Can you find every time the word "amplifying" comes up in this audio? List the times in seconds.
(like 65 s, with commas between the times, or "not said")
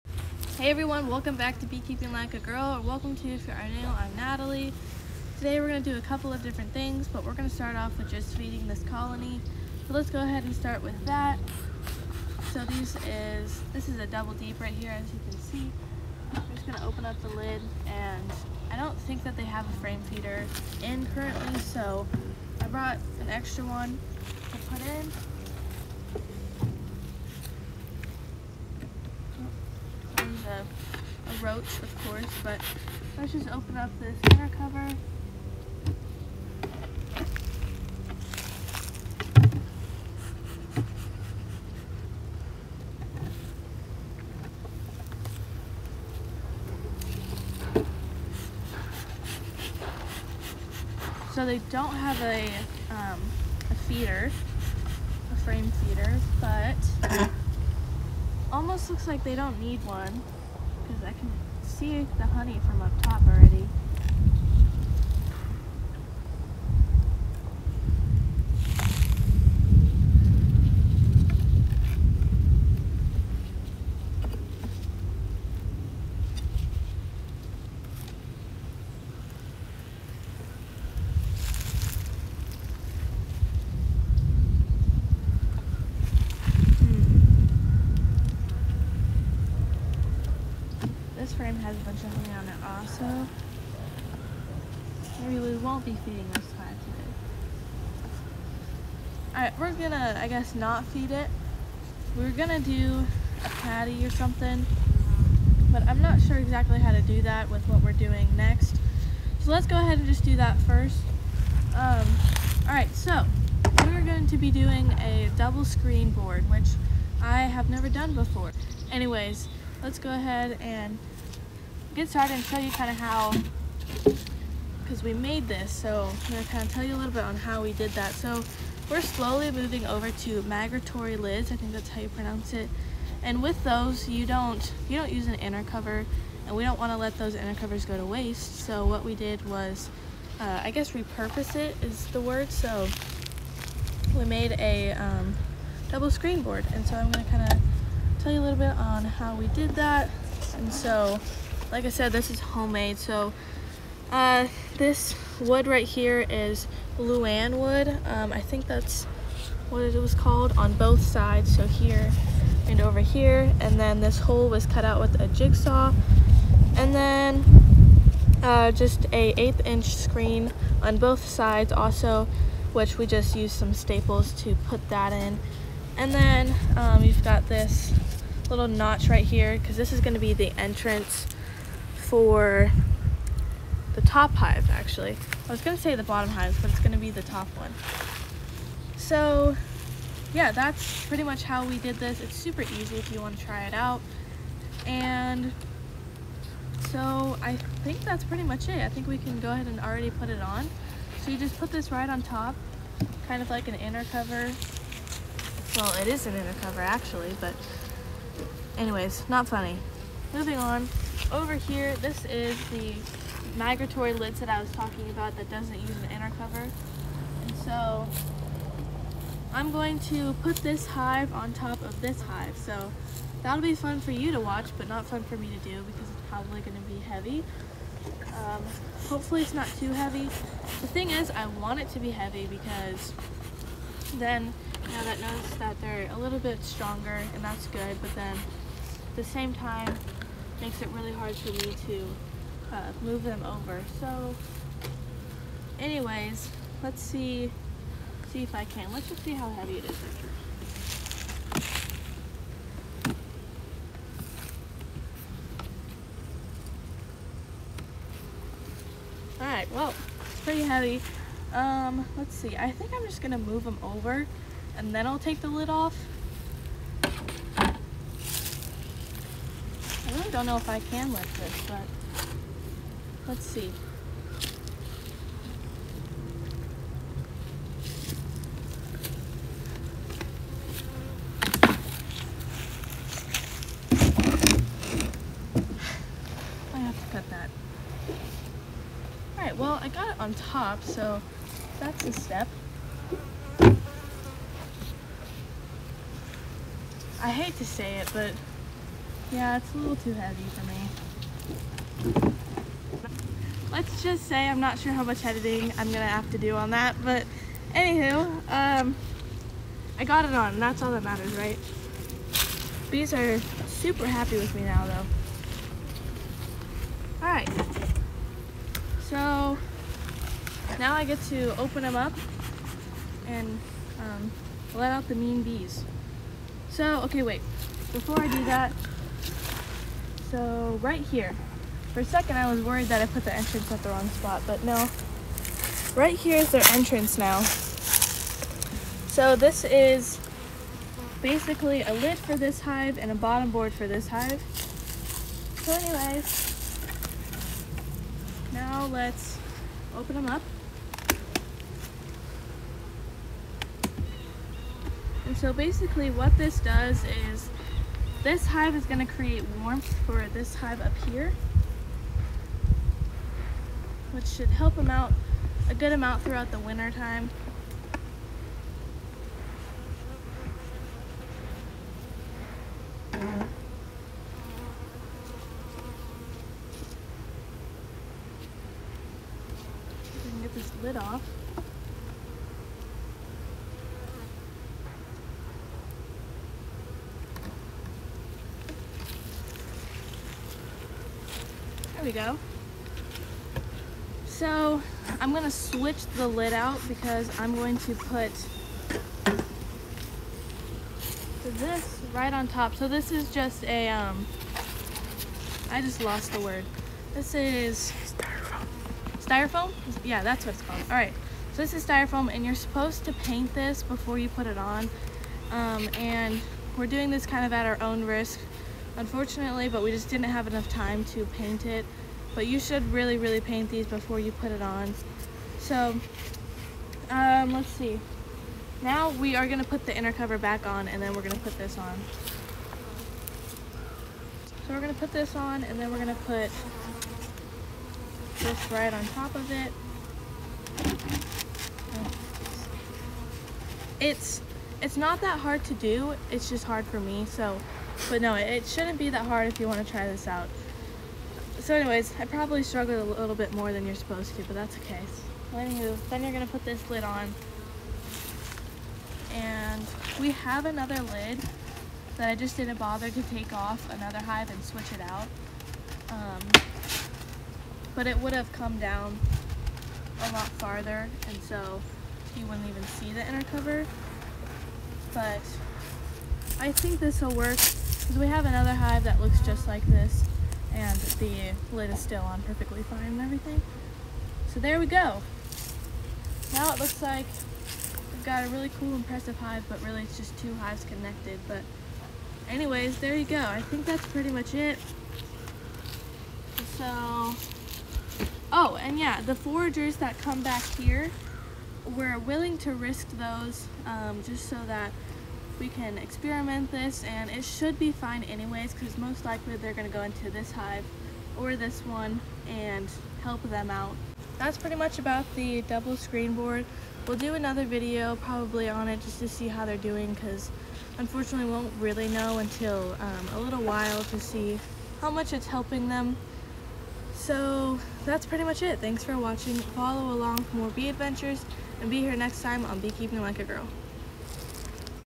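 not said.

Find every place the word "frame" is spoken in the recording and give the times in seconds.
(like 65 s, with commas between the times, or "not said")
19 s, 55 s.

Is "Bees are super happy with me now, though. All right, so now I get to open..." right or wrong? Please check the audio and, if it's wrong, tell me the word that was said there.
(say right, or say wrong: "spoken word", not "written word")
right.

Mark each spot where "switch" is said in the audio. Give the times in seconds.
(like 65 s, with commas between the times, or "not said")
395 s, 464 s.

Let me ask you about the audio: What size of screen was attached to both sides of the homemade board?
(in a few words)
1/8 inch.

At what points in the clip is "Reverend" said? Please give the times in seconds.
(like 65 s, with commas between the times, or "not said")
not said.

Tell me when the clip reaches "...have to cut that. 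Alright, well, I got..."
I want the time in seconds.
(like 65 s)
286 s.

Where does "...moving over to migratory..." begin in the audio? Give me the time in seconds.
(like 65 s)
129 s.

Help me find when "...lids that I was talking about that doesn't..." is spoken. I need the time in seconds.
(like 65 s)
214 s.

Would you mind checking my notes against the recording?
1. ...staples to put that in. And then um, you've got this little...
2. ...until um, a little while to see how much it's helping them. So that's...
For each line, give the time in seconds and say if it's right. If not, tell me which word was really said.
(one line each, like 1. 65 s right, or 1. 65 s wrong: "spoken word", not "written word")
1. 173 s right
2. 522 s right.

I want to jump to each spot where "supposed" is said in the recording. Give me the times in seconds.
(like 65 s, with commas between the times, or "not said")
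412 s, 453 s.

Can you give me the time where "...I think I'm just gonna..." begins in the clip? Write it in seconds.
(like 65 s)
262 s.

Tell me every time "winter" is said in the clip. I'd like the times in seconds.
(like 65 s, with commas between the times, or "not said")
366 s.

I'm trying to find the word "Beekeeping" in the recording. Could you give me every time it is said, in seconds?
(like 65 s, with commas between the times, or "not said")
1 s, 532 s.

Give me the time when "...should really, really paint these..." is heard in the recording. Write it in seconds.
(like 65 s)
422 s.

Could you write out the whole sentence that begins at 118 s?
Anyways, let's go ahead and get started and show you kind of how because we made this.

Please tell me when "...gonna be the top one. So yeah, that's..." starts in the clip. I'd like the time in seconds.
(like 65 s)
186 s.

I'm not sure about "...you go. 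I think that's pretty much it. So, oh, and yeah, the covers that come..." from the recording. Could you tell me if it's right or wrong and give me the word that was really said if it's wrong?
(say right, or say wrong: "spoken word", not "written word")
wrong: "foragers", not "covers".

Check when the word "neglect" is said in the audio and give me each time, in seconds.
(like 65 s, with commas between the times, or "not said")
not said.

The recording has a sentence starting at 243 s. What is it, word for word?
So anyways, let's see, see if I can.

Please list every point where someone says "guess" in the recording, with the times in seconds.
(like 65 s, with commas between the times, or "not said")
100 s, 140 s.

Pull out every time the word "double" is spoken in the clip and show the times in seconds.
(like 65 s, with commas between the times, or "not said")
14 s, 115 s, 145 s, 515 s.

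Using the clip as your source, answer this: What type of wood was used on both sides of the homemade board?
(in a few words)
lauan.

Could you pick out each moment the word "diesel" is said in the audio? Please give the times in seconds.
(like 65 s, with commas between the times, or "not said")
not said.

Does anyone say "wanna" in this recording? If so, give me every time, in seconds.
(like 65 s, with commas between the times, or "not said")
193 s, 449 s.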